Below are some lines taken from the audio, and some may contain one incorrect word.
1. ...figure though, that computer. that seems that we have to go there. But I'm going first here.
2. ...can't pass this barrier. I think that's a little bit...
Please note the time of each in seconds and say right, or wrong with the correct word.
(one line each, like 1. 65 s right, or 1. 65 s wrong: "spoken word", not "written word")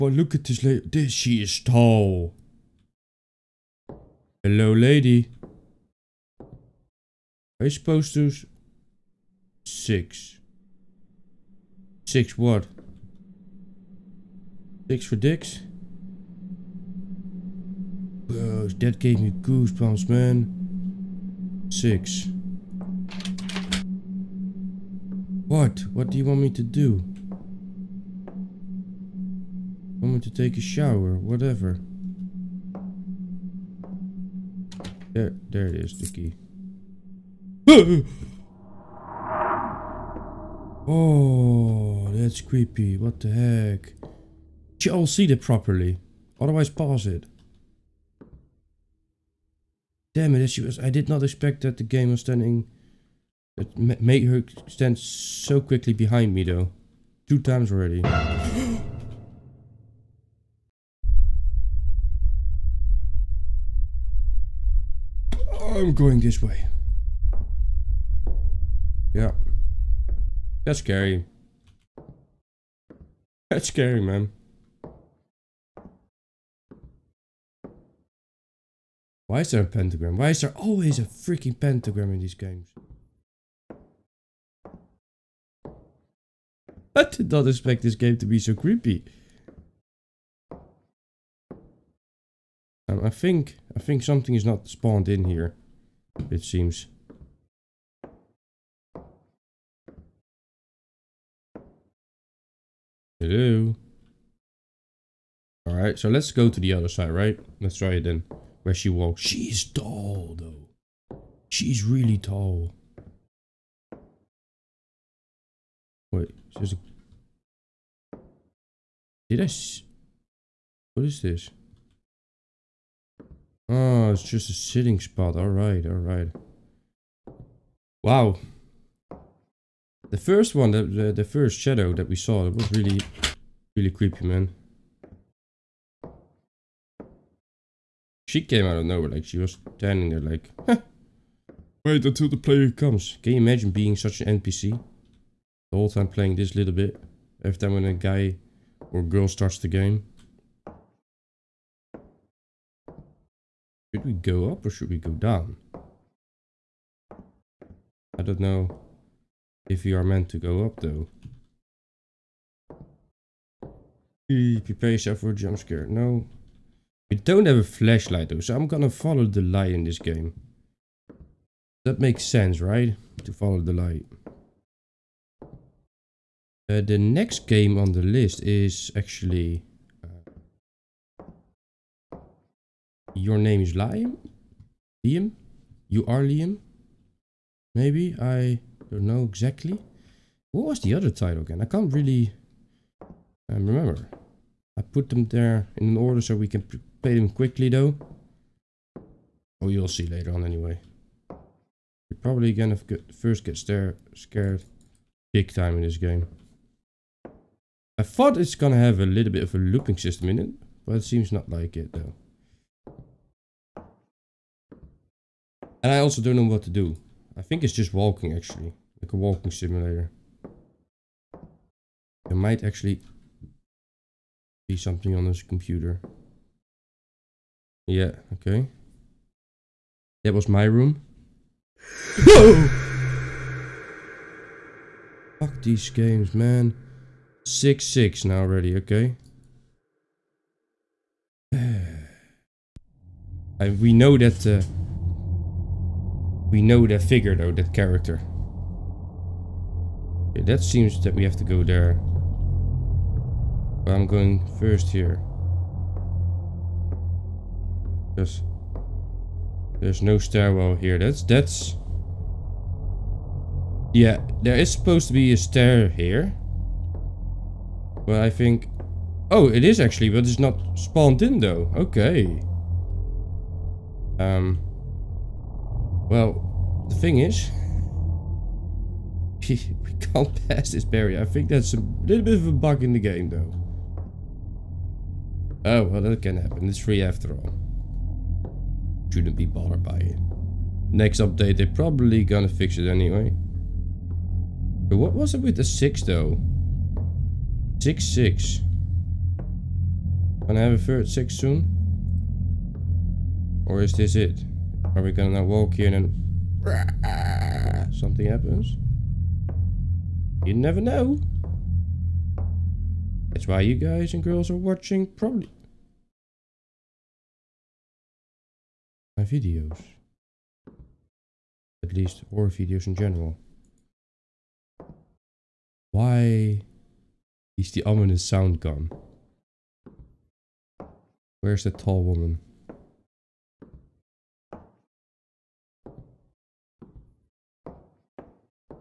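1. 247 s wrong: "character", not "computer"
2. 279 s right.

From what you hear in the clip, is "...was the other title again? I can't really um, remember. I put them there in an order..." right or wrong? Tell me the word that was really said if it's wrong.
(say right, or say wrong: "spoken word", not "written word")
right.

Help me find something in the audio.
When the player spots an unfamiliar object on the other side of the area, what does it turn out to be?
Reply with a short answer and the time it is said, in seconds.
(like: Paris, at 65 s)
a sitting spot, at 124 s.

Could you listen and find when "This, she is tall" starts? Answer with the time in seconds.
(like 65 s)
0 s.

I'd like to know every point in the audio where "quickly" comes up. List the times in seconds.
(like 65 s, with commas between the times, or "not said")
55 s, 197 s.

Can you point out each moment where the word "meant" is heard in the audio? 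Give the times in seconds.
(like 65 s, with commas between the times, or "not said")
160 s.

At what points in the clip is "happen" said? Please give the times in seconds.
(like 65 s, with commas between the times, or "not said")
286 s, 308 s.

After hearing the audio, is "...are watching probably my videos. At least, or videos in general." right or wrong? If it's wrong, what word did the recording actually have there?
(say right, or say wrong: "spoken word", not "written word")
right.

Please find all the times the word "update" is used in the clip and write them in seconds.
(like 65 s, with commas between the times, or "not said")
291 s.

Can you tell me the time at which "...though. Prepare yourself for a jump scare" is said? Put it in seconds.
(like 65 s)
160 s.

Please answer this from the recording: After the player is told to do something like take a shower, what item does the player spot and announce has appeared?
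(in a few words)
the key.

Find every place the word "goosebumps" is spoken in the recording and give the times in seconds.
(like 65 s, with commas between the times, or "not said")
19 s.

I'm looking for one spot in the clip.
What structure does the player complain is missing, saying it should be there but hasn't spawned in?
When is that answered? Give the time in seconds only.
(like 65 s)
260 s.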